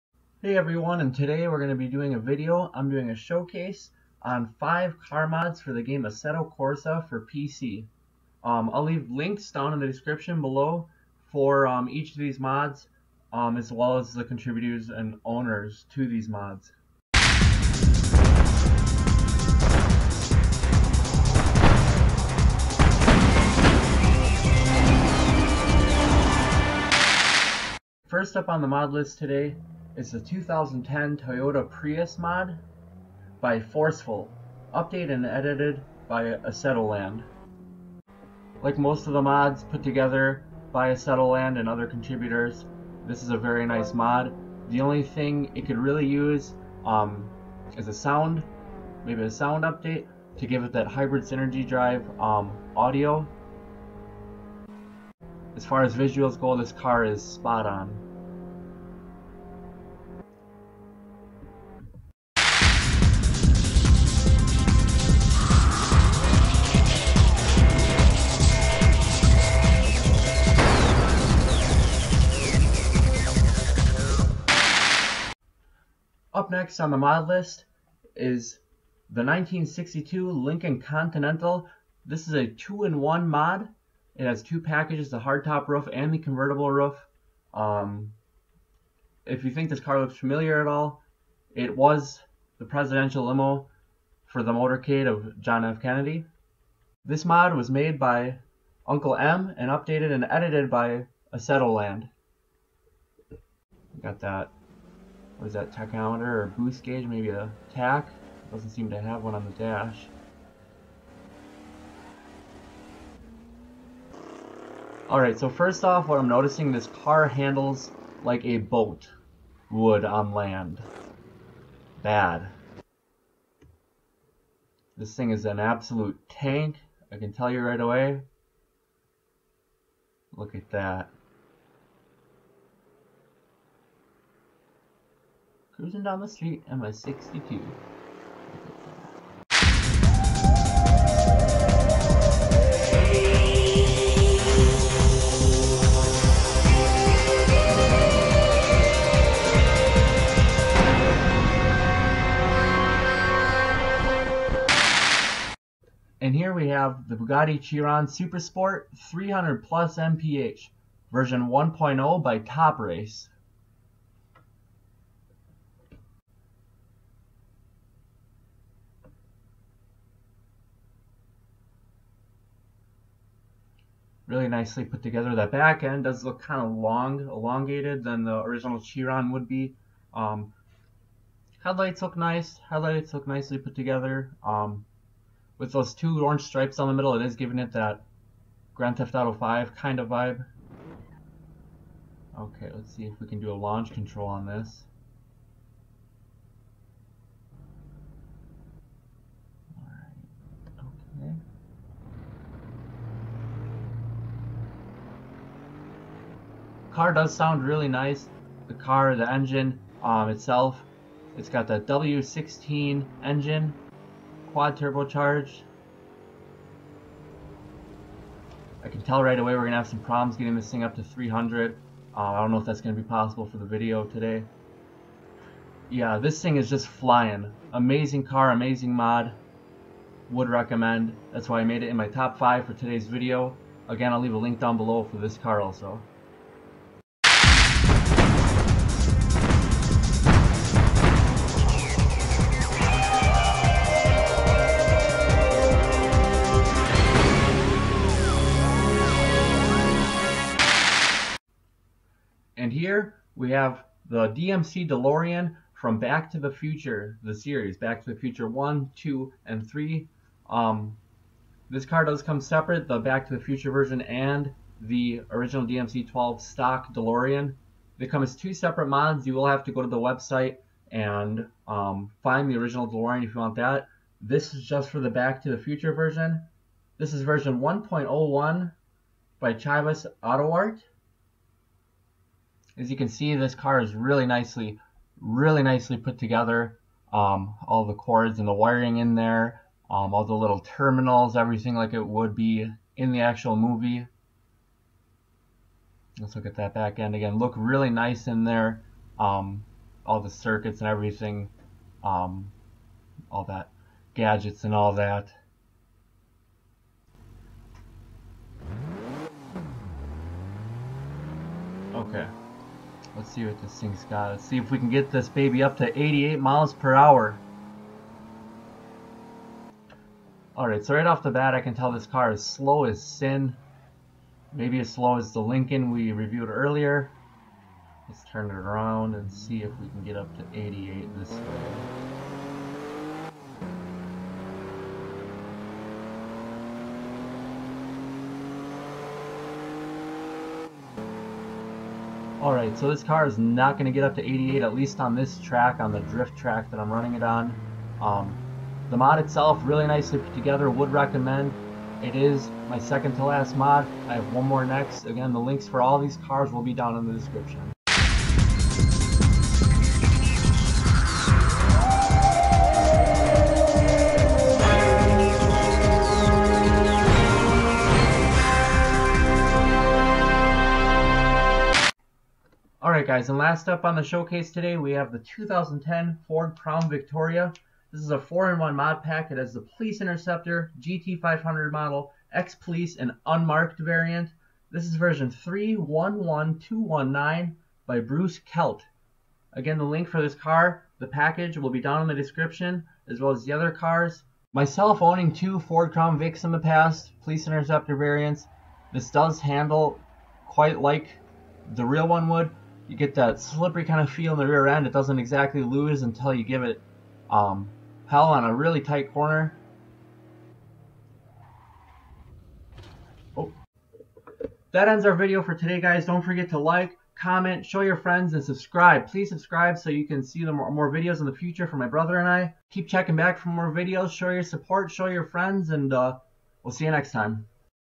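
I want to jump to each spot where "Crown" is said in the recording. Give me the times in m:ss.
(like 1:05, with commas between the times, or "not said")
6:16, 6:35.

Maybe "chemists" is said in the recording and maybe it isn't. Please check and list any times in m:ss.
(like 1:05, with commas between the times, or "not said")
not said.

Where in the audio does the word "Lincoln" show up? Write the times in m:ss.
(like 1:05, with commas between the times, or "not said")
1:20, 5:25.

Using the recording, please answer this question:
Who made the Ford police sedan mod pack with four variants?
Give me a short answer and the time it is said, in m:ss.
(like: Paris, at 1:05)
Bruce Kelt, at 6:27.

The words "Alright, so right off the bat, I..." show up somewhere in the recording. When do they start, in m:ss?
5:20.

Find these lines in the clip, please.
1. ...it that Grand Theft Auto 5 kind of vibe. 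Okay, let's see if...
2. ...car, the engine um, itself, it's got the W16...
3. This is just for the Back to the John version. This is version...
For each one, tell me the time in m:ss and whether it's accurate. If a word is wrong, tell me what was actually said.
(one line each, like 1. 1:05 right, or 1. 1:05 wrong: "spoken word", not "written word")
1. 3:07 right
2. 3:28 right
3. 4:34 wrong: "Future", not "John".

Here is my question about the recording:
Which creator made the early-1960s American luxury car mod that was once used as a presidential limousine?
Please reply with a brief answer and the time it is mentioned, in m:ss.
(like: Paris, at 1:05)
Uncle M, at 1:38.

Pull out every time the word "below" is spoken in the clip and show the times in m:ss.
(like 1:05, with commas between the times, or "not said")
0:10, 3:54.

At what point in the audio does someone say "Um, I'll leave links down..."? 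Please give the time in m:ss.
0:08.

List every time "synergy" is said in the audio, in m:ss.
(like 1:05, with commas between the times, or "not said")
0:51.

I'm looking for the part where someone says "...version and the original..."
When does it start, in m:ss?
4:23.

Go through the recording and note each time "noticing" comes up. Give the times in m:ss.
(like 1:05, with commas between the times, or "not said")
1:56.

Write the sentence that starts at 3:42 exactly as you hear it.
Uh, I don't know if that's going to be possible for the video today.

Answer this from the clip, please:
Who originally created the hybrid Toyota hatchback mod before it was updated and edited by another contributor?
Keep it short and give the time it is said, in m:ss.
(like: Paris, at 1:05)
Forceful, at 0:33.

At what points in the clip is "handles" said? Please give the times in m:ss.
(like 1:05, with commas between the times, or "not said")
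1:57, 6:39.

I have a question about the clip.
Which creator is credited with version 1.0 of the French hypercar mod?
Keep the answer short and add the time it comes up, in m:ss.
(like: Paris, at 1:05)
Top Race, at 2:42.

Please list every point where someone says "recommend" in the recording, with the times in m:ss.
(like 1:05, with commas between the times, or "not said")
3:50, 5:50.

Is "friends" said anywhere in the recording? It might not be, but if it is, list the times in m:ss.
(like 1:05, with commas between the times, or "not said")
6:57, 7:05.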